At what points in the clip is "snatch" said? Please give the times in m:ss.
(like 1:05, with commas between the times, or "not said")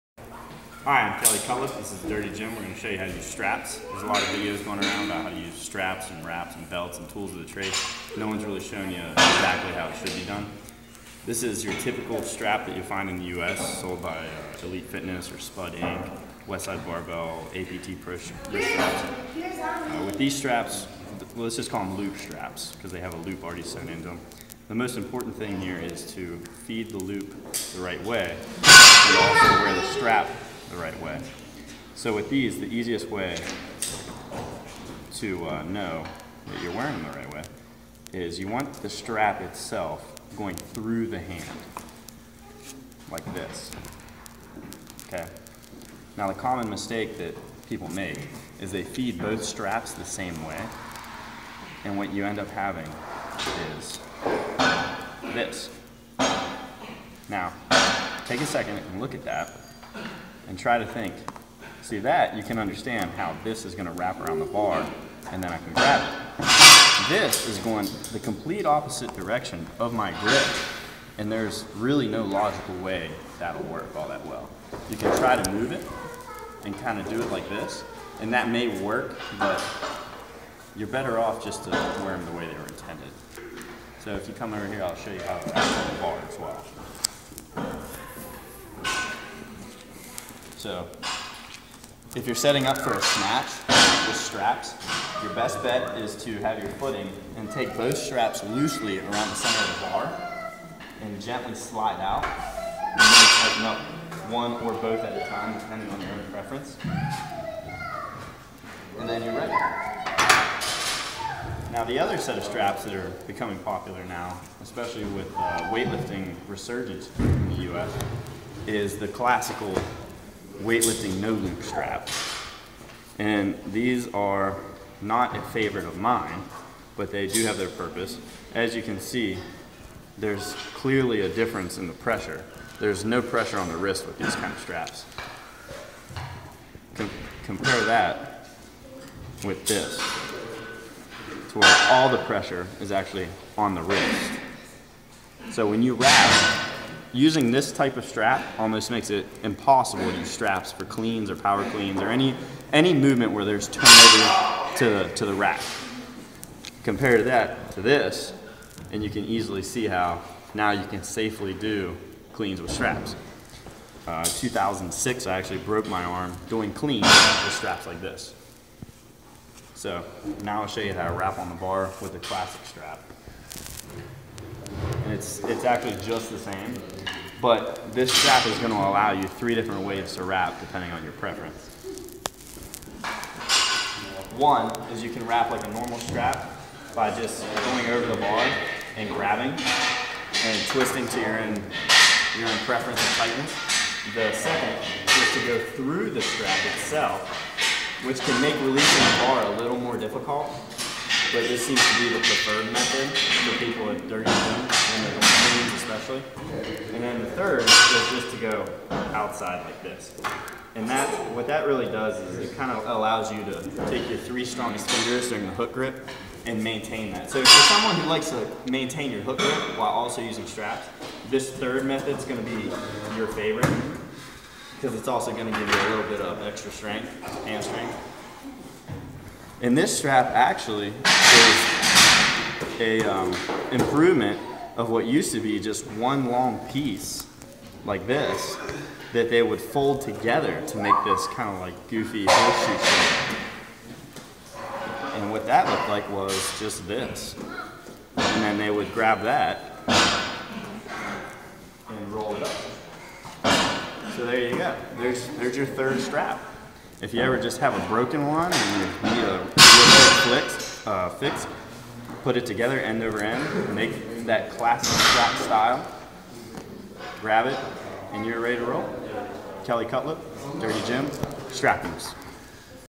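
1:33.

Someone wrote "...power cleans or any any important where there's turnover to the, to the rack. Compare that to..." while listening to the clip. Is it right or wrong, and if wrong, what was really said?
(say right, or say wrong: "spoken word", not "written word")
wrong: "movement", not "important".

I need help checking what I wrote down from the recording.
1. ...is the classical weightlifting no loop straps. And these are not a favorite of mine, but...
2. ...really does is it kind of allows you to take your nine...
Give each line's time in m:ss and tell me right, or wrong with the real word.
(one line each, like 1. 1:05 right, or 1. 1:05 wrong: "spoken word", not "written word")
1. 1:58 right
2. 3:31 wrong: "three", not "nine".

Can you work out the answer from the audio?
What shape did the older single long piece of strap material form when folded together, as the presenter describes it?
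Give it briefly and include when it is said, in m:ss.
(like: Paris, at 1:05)
Horseshoe, at 4:02.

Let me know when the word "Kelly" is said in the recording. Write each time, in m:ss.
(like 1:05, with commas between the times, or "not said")
0:01, 4:29.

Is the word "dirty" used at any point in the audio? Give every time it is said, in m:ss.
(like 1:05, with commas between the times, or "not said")
0:02, 3:24, 4:30.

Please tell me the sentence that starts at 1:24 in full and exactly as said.
So if you come over here, I'll show you how to wrap the bar as well.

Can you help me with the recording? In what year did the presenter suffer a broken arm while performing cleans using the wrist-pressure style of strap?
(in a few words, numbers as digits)
2006.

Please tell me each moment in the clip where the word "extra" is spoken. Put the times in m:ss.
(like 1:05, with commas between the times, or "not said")
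3:46.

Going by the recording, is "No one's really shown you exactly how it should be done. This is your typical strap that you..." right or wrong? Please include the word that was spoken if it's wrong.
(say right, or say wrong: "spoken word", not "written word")
right.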